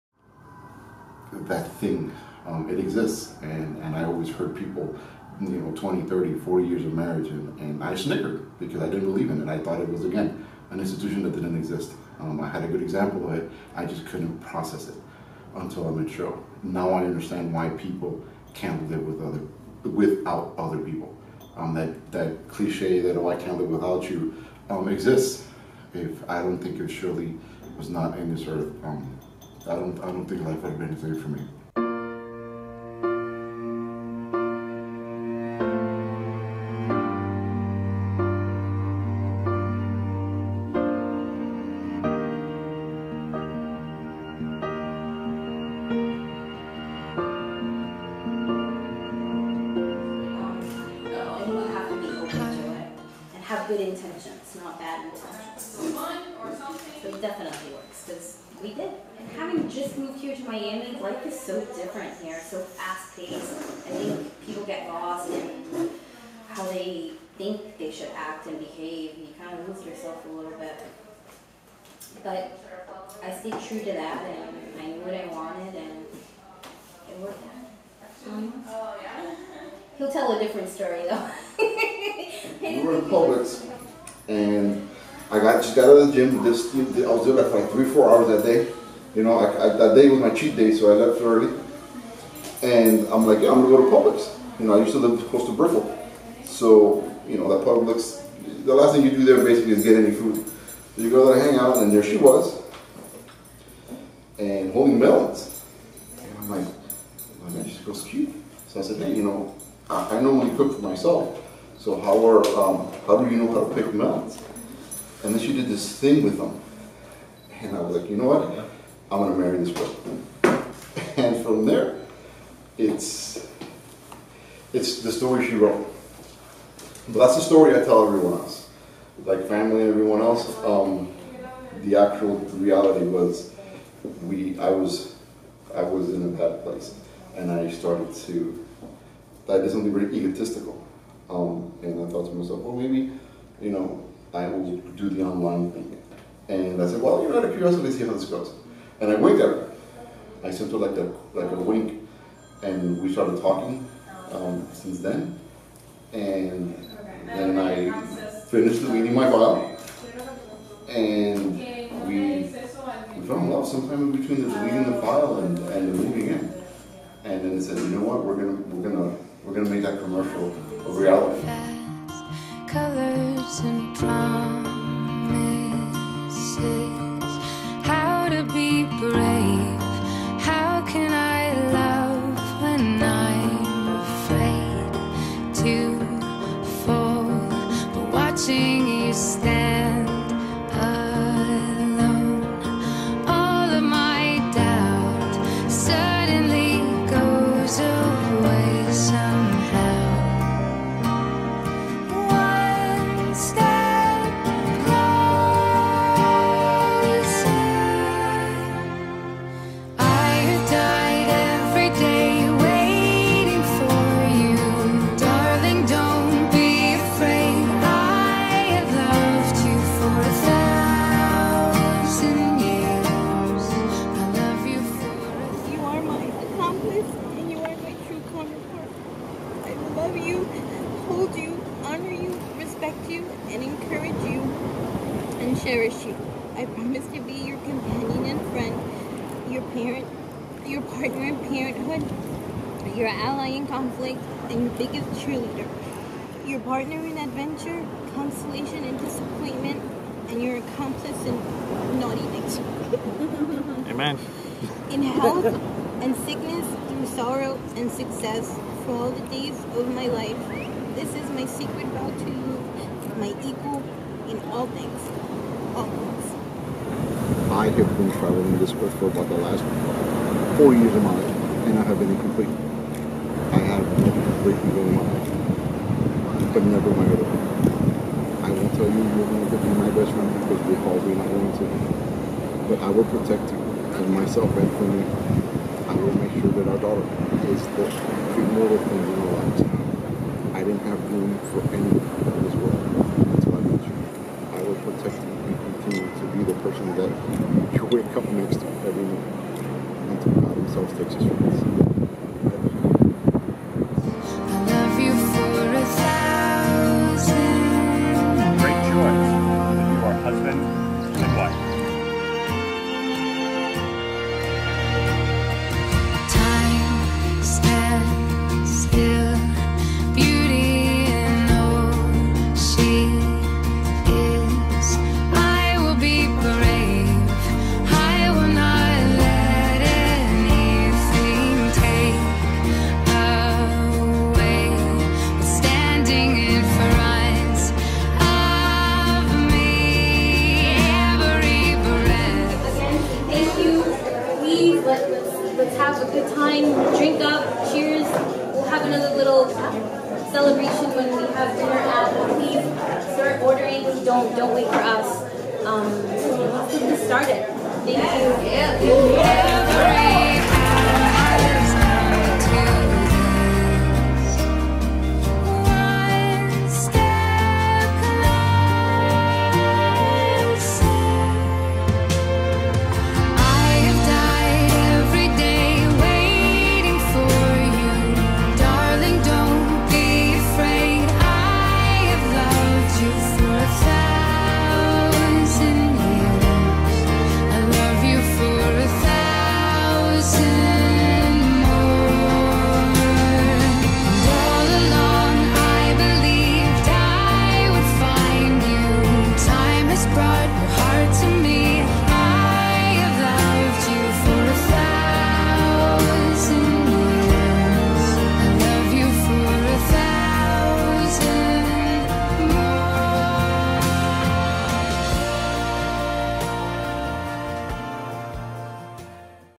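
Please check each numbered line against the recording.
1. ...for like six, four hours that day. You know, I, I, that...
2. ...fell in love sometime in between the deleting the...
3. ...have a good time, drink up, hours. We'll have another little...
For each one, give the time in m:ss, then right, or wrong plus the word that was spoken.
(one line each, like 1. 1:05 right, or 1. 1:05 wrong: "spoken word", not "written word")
1. 1:27 wrong: "three", not "six"
2. 2:43 right
3. 5:45 wrong: "cheers", not "hours".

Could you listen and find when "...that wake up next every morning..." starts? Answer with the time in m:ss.
4:56.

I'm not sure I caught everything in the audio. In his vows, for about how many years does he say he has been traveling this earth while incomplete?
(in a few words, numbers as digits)
4 years.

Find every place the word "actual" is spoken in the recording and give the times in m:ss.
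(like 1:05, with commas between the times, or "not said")
2:11.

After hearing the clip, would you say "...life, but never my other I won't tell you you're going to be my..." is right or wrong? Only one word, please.
right.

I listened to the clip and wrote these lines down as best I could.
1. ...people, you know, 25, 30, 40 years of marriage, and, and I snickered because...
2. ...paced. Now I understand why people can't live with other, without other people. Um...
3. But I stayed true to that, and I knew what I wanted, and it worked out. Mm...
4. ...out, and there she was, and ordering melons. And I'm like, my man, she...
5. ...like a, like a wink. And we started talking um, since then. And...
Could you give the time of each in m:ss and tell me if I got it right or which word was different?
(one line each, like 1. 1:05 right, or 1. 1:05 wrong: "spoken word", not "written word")
1. 0:04 wrong: "20", not "25"
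2. 0:15 wrong: "matured", not "paced"
3. 1:12 right
4. 1:41 wrong: "holding", not "ordering"
5. 2:30 right.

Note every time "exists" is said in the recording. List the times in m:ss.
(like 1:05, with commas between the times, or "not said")
0:02, 0:11, 0:24.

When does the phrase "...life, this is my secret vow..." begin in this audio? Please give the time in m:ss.
4:20.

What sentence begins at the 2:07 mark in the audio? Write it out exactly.
But that's the story I tell everyone else, like family and everyone else.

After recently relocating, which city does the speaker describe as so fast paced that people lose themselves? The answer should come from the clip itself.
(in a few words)
Miami.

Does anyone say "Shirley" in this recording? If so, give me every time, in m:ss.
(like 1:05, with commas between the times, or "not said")
0:26.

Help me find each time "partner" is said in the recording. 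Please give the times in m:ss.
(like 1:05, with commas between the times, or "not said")
4:00, 4:06.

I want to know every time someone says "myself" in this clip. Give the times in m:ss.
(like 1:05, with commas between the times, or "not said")
1:50, 2:22, 4:44.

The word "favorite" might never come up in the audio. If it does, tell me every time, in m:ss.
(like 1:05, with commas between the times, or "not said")
not said.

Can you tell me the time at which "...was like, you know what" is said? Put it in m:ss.
1:57.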